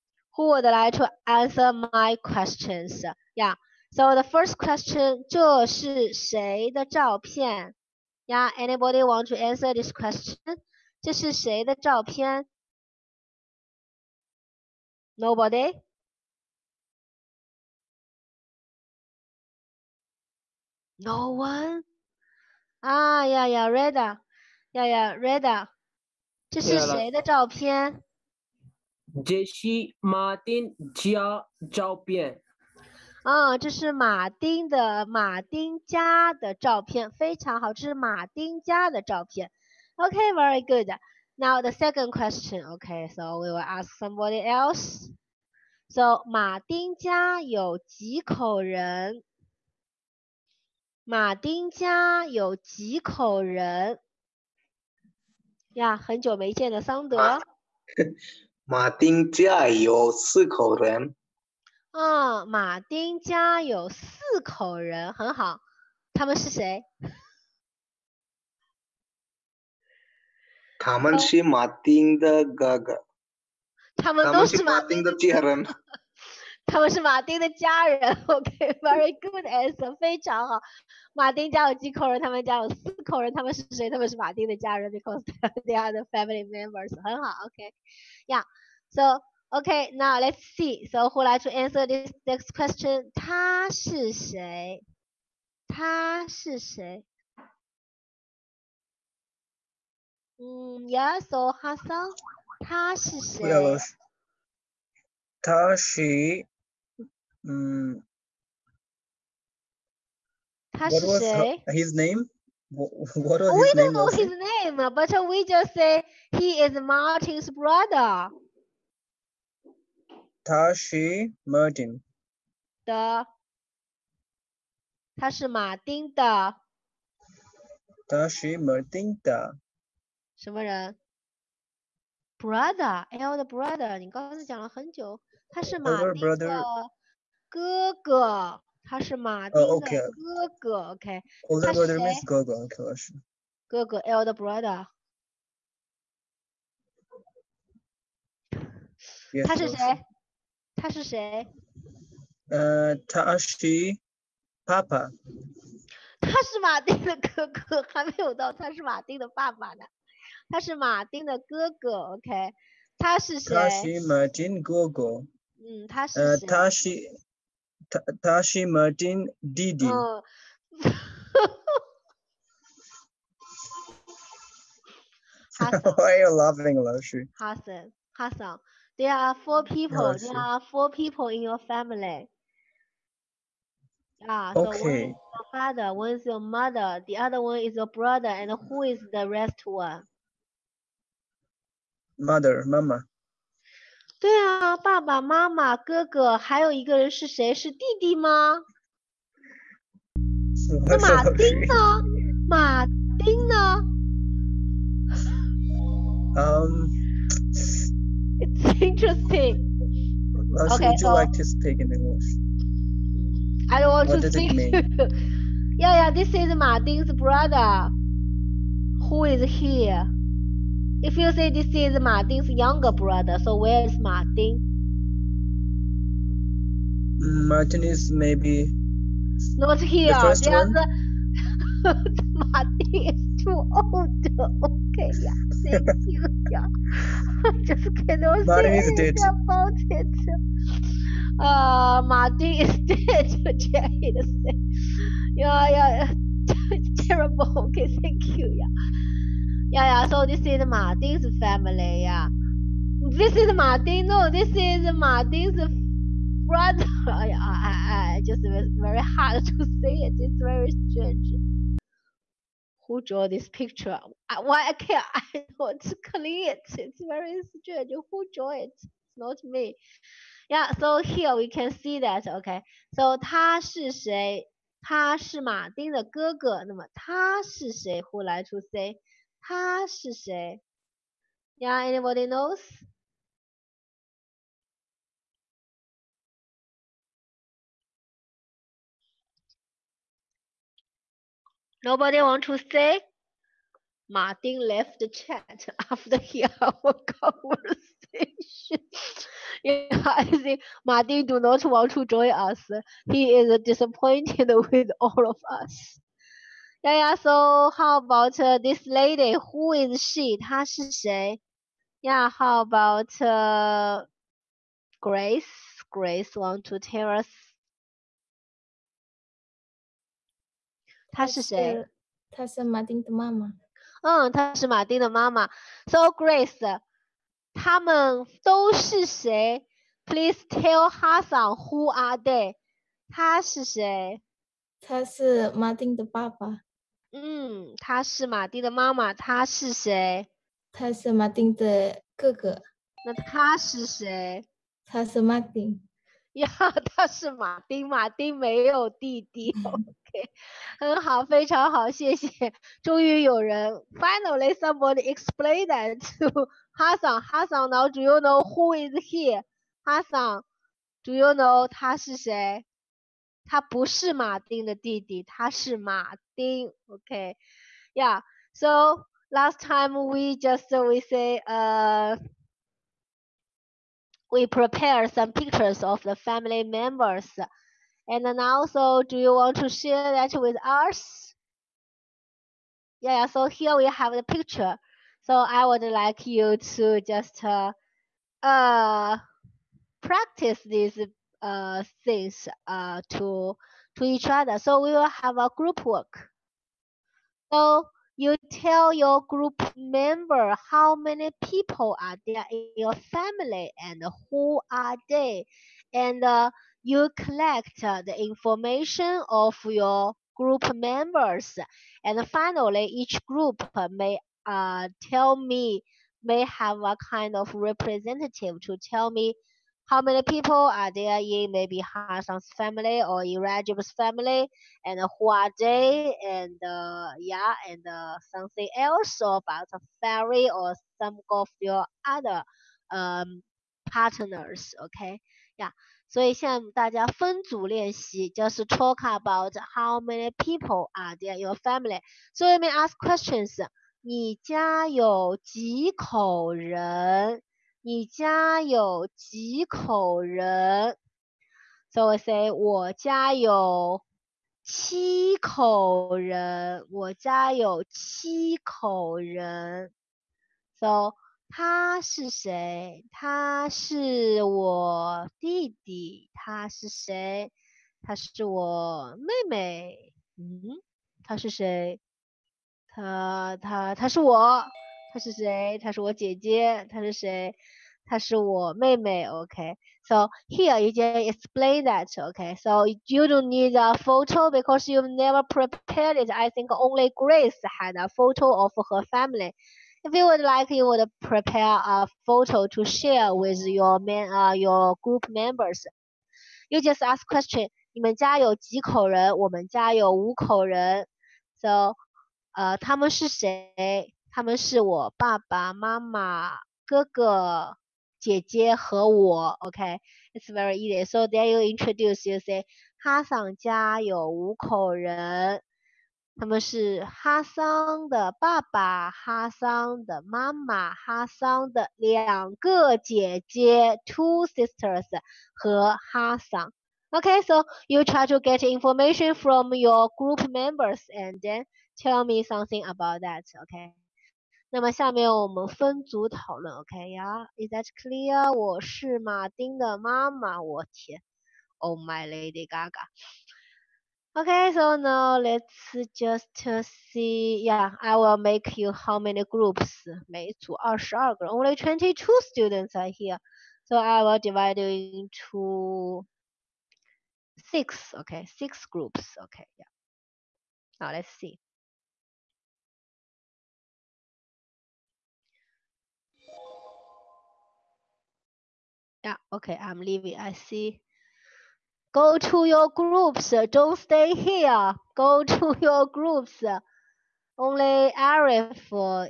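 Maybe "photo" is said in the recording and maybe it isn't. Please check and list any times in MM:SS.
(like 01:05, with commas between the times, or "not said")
08:03, 08:08, 08:12.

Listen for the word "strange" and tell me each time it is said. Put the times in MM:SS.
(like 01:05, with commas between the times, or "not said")
04:20, 04:27.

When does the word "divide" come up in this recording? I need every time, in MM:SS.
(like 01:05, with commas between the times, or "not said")
09:14.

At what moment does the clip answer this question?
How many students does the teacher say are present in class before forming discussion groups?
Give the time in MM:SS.
09:11.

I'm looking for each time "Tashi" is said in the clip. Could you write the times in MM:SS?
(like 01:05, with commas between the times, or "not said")
02:00, 02:48.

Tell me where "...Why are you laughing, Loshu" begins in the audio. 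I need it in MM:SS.
02:55.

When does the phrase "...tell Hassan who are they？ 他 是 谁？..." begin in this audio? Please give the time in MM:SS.
05:30.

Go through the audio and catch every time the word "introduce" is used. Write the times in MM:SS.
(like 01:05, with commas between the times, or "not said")
08:31.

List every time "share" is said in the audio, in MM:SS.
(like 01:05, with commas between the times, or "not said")
06:19, 08:12.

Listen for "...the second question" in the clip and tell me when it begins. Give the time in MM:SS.
00:41.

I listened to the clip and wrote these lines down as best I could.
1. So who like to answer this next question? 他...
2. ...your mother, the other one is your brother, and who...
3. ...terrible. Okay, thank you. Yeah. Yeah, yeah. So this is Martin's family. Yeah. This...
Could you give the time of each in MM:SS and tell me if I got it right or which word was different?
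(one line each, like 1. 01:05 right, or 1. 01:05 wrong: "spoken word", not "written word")
1. 01:30 right
2. 03:06 right
3. 04:07 right.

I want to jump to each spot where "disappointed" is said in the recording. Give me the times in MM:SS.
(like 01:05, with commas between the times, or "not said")
05:03.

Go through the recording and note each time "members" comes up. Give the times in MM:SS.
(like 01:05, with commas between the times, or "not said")
01:26, 06:16, 06:39, 06:50, 08:15, 08:50.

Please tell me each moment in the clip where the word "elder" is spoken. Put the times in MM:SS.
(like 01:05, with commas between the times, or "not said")
02:13, 02:24.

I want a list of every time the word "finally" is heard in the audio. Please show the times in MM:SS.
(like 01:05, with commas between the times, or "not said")
05:53, 06:52.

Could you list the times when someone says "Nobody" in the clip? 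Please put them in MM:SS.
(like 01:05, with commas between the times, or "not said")
00:15, 04:51.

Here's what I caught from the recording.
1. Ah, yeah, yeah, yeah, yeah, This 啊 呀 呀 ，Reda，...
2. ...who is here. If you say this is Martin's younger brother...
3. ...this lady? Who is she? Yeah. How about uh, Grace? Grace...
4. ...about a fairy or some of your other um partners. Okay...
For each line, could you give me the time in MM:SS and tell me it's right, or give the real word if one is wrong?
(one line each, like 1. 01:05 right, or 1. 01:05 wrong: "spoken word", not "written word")
1. 00:22 right
2. 03:39 right
3. 05:08 right
4. 07:09 right.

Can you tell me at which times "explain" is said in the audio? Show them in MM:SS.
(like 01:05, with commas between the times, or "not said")
08:01.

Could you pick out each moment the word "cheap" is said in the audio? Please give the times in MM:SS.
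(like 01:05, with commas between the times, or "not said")
not said.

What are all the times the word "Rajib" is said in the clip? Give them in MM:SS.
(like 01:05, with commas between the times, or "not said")
07:03.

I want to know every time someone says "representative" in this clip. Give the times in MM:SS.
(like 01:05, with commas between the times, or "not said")
06:57.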